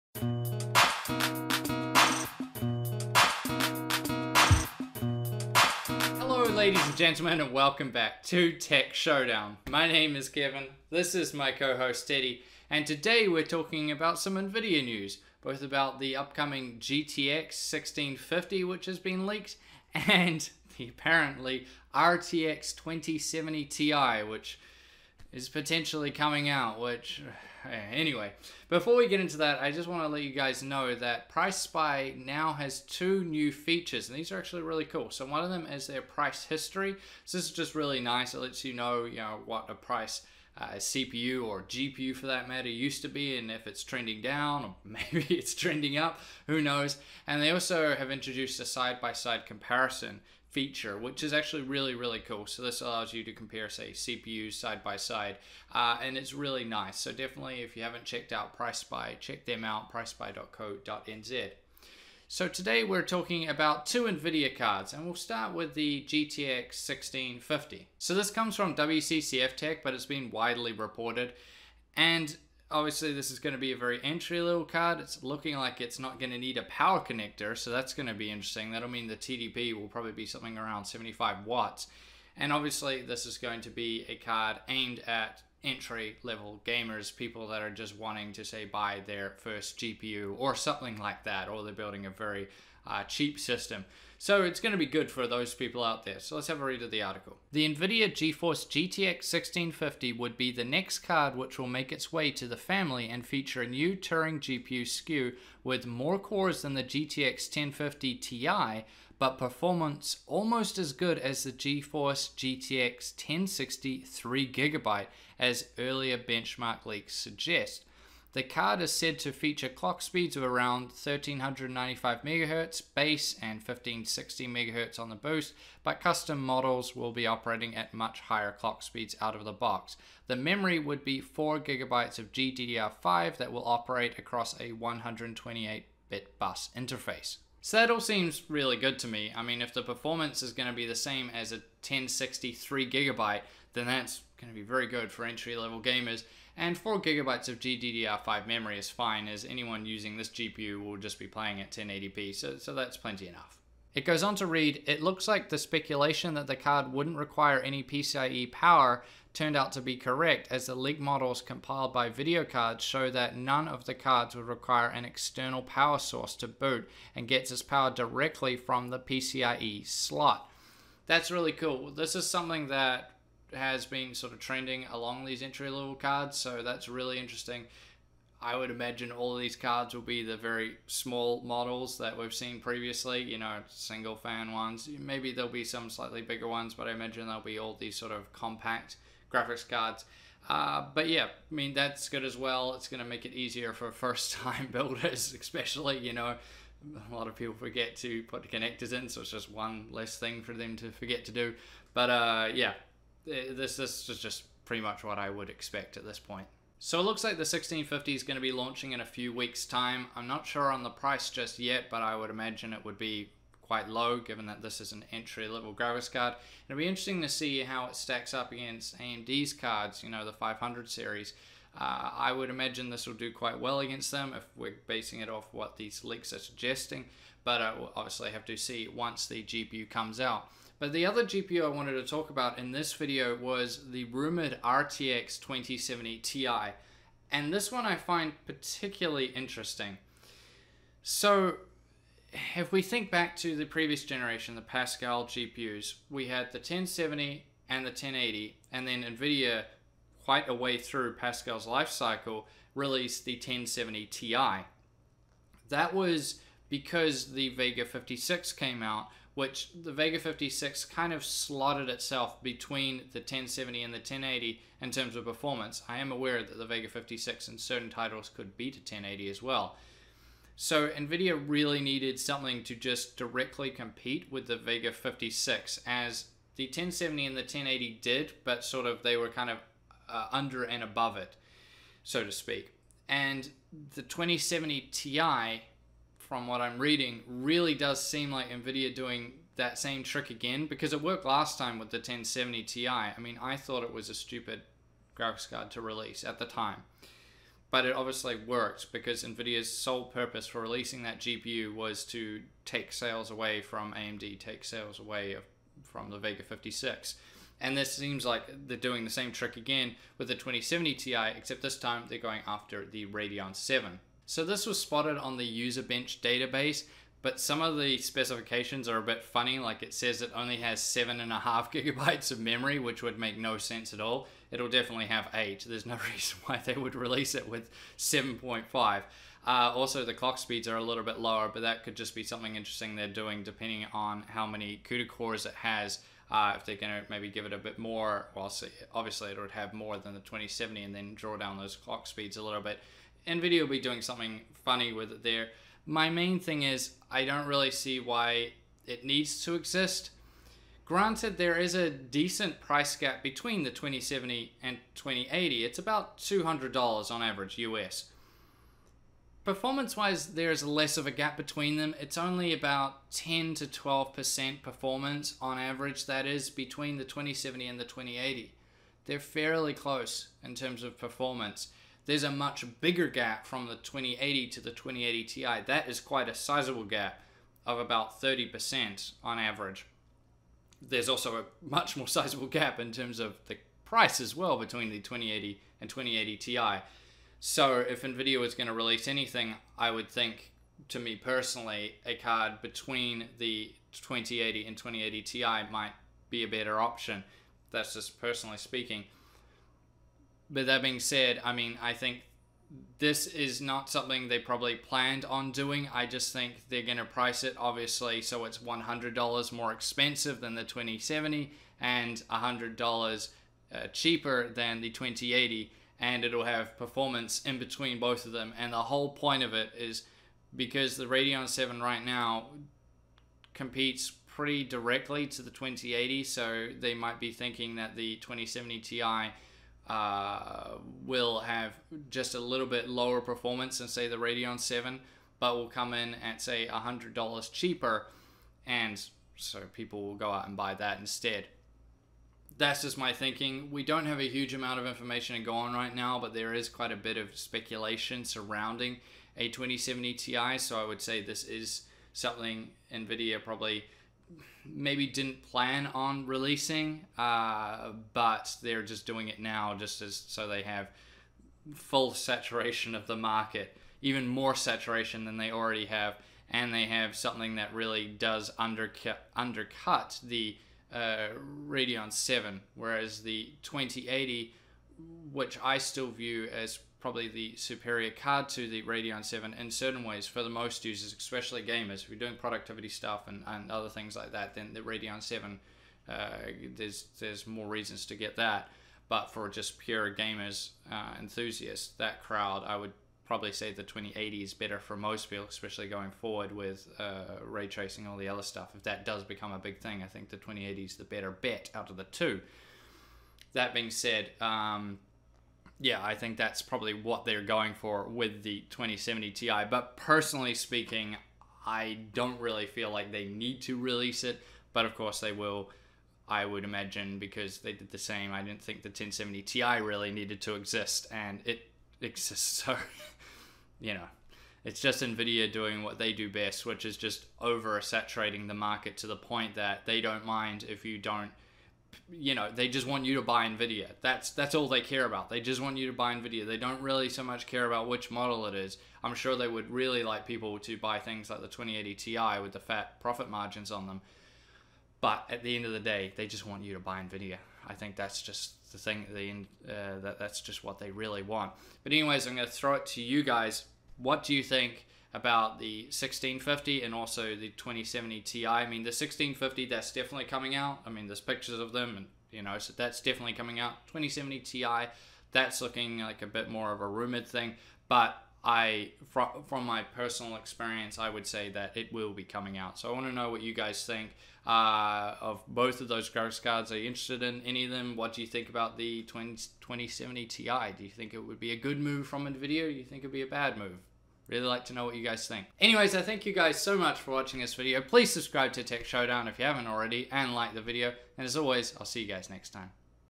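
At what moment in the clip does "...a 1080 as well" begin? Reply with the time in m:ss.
4:28.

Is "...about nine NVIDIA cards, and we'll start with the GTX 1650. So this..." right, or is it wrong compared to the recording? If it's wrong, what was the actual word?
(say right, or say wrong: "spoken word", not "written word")
wrong: "two", not "nine".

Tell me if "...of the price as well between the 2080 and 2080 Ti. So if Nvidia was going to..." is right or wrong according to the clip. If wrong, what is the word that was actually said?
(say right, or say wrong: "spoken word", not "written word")
right.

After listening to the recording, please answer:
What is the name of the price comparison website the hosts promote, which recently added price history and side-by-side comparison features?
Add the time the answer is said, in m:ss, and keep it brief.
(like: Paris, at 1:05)
PriceSpy, at 0:59.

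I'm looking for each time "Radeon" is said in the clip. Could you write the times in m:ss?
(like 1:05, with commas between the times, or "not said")
5:13, 7:01, 7:14, 7:51, 7:58, 8:04.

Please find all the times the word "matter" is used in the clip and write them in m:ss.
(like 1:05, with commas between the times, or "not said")
0:42.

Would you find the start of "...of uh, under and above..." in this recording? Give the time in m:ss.
4:39.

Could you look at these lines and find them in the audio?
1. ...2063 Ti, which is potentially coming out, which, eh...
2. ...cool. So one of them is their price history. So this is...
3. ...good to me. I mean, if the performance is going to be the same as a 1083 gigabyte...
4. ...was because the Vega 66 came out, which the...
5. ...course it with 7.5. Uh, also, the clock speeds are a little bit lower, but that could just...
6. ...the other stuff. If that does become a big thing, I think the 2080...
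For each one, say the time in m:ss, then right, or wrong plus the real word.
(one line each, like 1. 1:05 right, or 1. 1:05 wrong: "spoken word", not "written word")
1. 0:22 wrong: "2070", not "2063"
2. 0:34 right
3. 2:18 wrong: "1063", not "1083"
4. 4:15 wrong: "56", not "66"
5. 5:26 wrong: "release", not "course"
6. 8:18 right.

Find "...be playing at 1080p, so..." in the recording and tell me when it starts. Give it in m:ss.
2:31.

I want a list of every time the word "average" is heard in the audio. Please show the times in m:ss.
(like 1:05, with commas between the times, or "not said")
5:57, 6:05, 6:19.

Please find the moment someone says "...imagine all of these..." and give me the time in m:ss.
2:58.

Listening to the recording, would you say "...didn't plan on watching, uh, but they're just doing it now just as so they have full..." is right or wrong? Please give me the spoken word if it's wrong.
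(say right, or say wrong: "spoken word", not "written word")
wrong: "releasing", not "watching".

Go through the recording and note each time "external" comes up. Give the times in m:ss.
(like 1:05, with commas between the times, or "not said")
2:45.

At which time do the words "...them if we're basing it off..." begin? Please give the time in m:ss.
3:44.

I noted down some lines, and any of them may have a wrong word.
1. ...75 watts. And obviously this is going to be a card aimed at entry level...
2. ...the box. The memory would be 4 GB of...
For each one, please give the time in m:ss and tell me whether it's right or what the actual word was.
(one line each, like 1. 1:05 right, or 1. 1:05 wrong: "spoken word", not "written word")
1. 1:20 right
2. 2:09 right.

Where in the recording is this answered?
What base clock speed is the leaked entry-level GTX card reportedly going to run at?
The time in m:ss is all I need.
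2:00.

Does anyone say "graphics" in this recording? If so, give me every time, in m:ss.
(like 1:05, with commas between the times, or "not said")
3:09, 3:35, 4:55, 9:36.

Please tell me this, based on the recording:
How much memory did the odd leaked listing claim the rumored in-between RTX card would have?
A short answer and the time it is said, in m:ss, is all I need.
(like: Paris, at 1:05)
7.5 GB, at 5:20.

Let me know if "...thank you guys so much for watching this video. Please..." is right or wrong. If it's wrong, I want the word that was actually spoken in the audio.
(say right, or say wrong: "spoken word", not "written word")
right.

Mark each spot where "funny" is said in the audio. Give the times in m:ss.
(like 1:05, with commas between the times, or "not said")
5:19, 5:44.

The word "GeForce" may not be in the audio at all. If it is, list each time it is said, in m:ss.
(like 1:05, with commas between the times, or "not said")
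1:38, 1:51.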